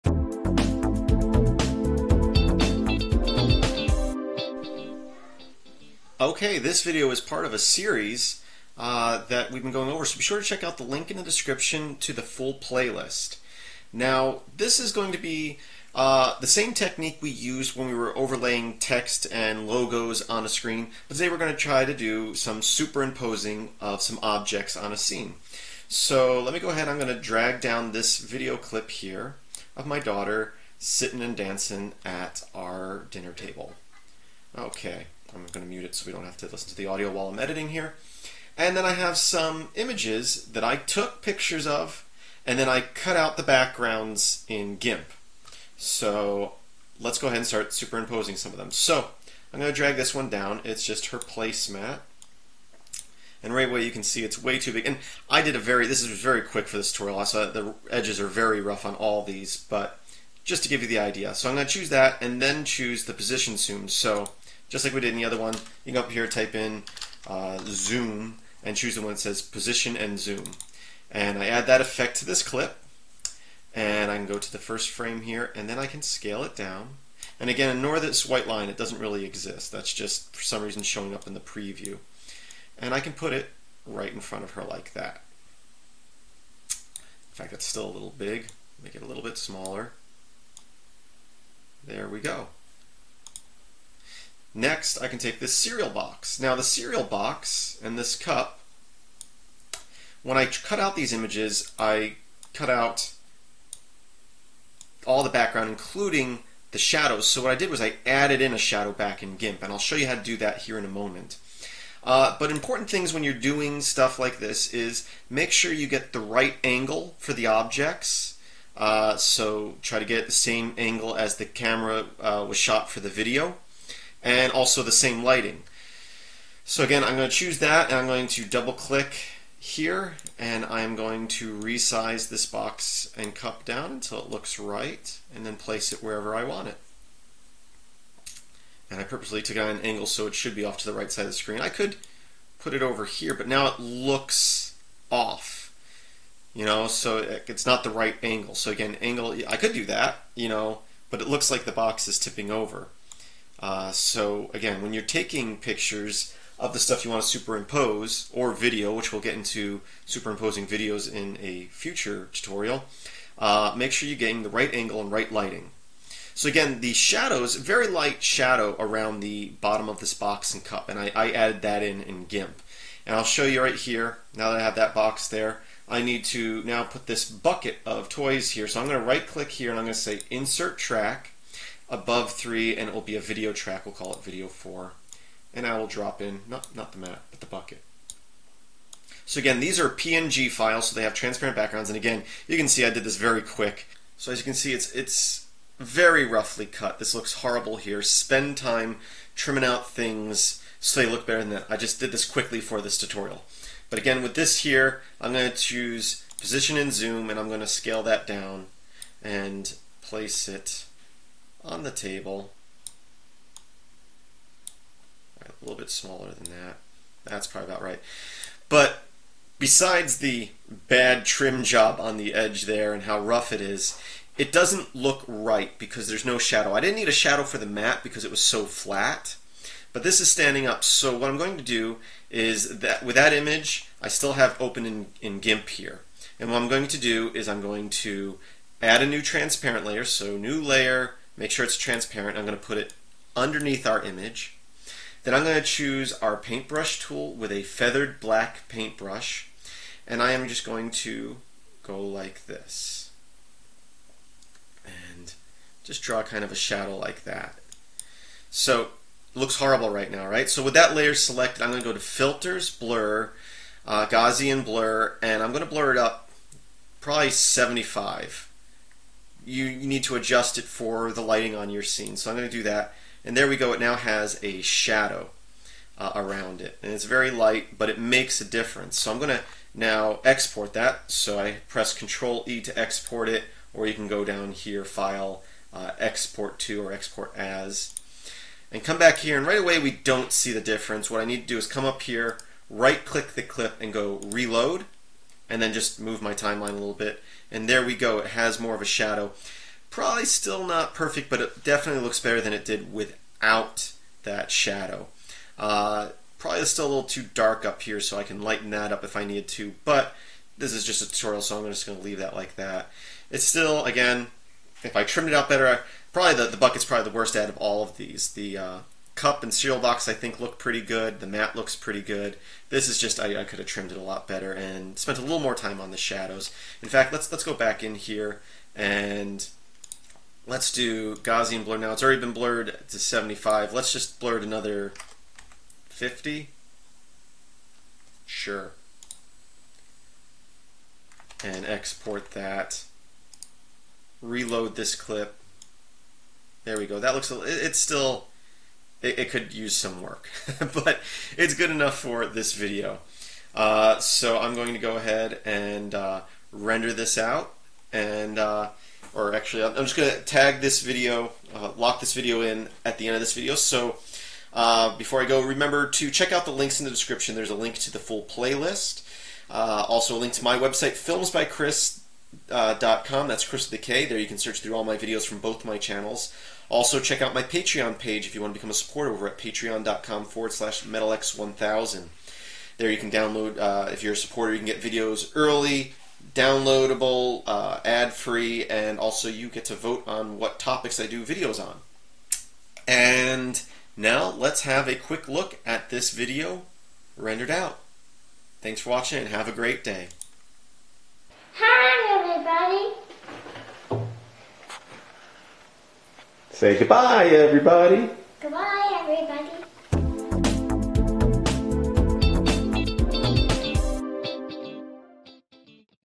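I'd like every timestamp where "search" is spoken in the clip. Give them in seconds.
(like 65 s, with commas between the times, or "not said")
374 s.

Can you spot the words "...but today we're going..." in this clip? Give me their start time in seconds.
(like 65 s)
21 s.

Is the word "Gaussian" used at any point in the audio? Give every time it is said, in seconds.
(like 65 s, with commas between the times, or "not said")
264 s, 331 s.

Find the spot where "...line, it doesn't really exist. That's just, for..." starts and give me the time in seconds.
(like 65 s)
78 s.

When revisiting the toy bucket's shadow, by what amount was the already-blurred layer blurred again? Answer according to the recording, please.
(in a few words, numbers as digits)
50.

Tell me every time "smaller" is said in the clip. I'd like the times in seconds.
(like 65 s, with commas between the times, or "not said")
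89 s, 215 s.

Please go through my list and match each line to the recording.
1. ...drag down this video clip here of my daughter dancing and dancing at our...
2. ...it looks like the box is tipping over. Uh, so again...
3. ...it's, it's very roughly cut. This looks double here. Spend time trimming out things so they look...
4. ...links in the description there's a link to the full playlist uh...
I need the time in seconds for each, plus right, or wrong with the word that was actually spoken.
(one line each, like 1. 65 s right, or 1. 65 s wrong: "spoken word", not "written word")
1. 27 s wrong: "sitting", not "dancing"
2. 151 s right
3. 194 s wrong: "horrible", not "double"
4. 366 s right.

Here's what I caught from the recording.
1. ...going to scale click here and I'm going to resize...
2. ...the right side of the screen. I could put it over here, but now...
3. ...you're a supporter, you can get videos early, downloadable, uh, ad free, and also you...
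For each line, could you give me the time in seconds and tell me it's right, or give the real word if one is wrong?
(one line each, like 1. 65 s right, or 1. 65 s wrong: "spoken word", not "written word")
1. 128 s wrong: "double", not "scale"
2. 140 s right
3. 384 s right.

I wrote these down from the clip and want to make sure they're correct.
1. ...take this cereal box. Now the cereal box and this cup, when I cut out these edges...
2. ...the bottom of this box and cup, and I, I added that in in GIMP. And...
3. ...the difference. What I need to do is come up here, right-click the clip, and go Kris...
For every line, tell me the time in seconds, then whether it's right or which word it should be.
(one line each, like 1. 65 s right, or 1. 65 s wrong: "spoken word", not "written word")
1. 95 s wrong: "images", not "edges"
2. 169 s right
3. 290 s wrong: "Reload", not "Kris".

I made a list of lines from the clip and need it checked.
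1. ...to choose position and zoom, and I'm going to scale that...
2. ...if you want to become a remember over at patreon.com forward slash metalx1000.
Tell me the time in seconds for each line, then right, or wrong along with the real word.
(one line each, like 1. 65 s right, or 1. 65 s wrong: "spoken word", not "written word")
1. 205 s right
2. 378 s wrong: "supporter", not "remember".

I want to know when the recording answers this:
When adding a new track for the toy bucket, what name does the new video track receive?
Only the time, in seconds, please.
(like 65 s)
184 s.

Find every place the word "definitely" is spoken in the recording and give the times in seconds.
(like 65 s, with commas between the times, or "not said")
301 s.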